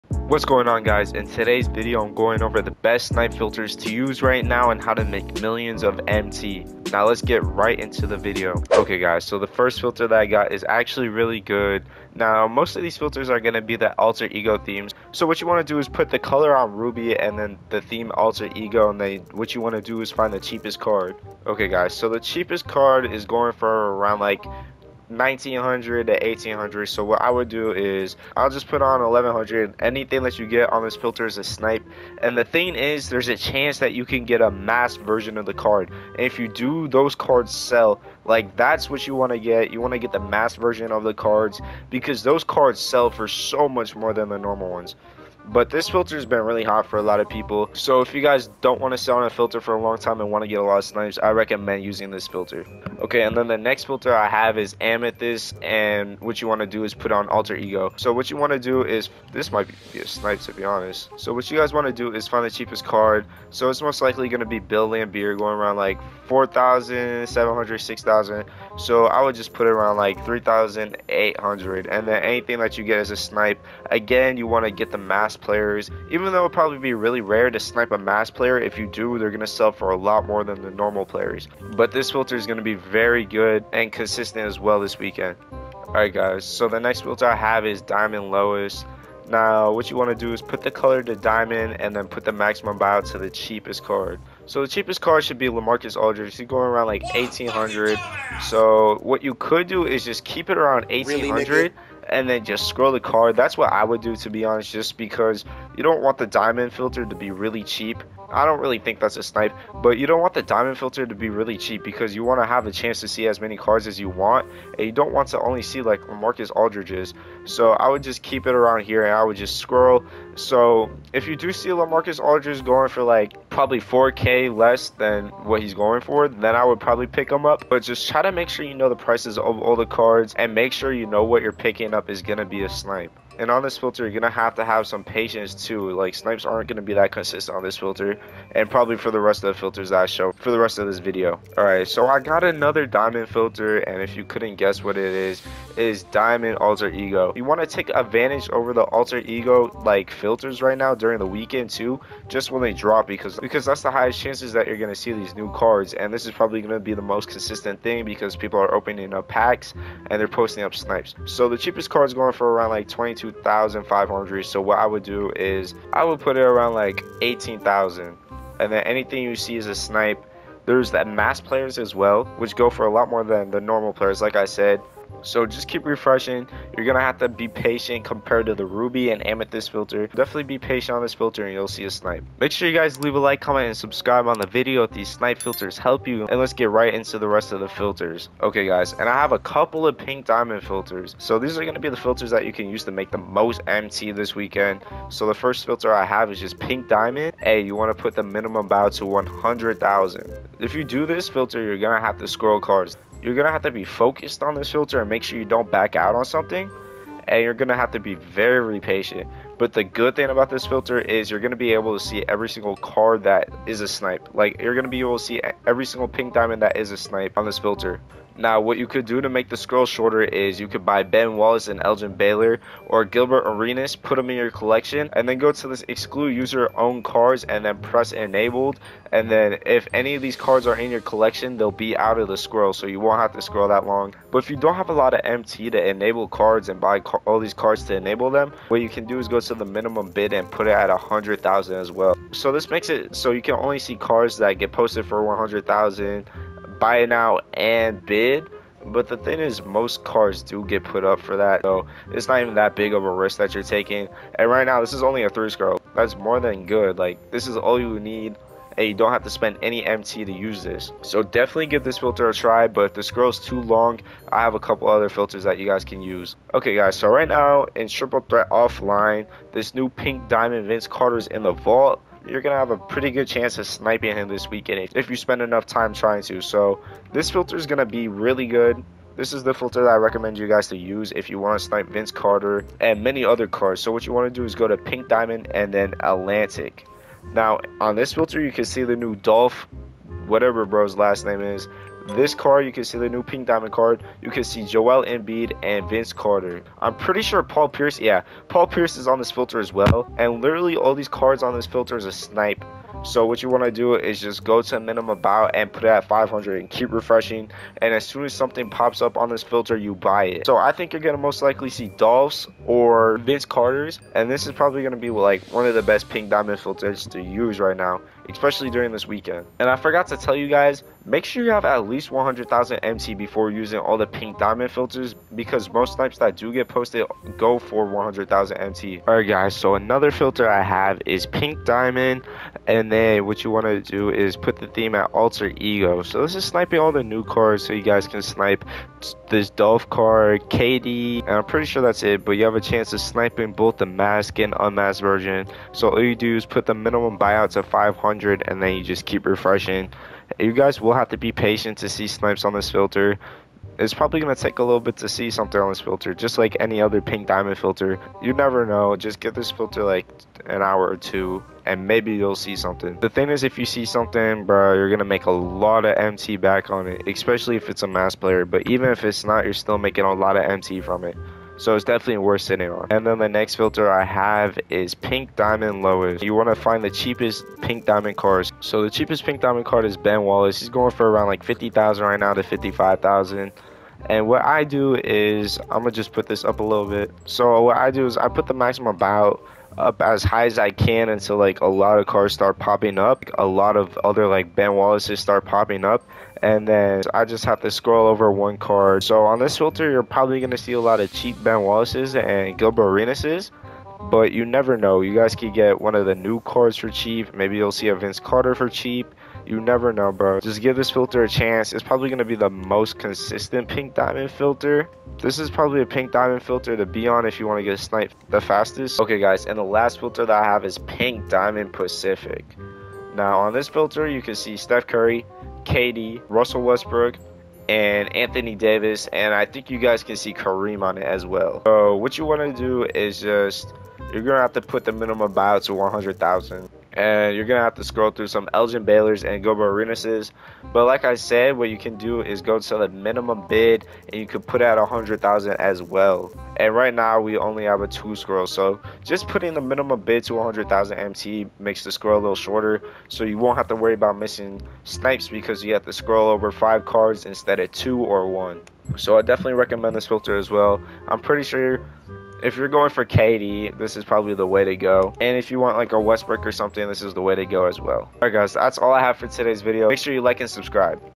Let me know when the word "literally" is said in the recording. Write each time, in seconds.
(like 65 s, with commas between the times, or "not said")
300 s.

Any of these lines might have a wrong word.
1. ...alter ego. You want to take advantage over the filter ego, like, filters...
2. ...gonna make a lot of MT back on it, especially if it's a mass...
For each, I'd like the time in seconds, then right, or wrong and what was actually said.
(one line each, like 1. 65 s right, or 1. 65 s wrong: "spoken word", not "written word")
1. 146 s wrong: "alter", not "filter"
2. 364 s right.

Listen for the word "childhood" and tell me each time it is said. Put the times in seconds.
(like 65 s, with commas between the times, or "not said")
not said.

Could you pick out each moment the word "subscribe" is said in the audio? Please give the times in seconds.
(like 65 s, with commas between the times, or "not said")
183 s, 470 s.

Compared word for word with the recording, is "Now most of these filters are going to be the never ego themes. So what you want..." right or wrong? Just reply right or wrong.
wrong.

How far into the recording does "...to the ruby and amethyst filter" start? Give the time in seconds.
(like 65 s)
178 s.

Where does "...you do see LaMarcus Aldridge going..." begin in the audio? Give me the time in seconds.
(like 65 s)
121 s.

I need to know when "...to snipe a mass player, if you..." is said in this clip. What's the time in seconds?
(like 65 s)
77 s.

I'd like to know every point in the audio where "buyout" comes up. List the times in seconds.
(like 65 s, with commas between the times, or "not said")
92 s, 347 s, 435 s.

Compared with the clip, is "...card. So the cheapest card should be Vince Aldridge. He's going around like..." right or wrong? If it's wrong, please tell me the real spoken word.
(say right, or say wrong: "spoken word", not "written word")
wrong: "LaMarcus", not "Vince".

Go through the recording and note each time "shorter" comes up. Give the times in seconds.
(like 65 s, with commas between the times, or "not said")
219 s, 452 s.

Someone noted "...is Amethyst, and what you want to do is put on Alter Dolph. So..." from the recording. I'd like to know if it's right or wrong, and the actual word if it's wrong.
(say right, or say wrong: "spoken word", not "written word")
wrong: "Ego", not "Dolph".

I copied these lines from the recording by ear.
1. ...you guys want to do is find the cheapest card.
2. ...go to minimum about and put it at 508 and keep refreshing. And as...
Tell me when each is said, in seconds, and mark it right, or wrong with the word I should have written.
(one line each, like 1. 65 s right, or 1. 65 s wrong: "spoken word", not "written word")
1. 61 s right
2. 304 s wrong: "500", not "508".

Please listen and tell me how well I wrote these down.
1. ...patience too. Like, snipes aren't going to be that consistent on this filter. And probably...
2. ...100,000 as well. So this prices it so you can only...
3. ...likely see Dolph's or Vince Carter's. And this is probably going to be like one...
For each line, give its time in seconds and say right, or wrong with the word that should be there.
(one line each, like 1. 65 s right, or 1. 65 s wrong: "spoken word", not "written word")
1. 135 s right
2. 240 s wrong: "makes", not "prices"
3. 311 s right.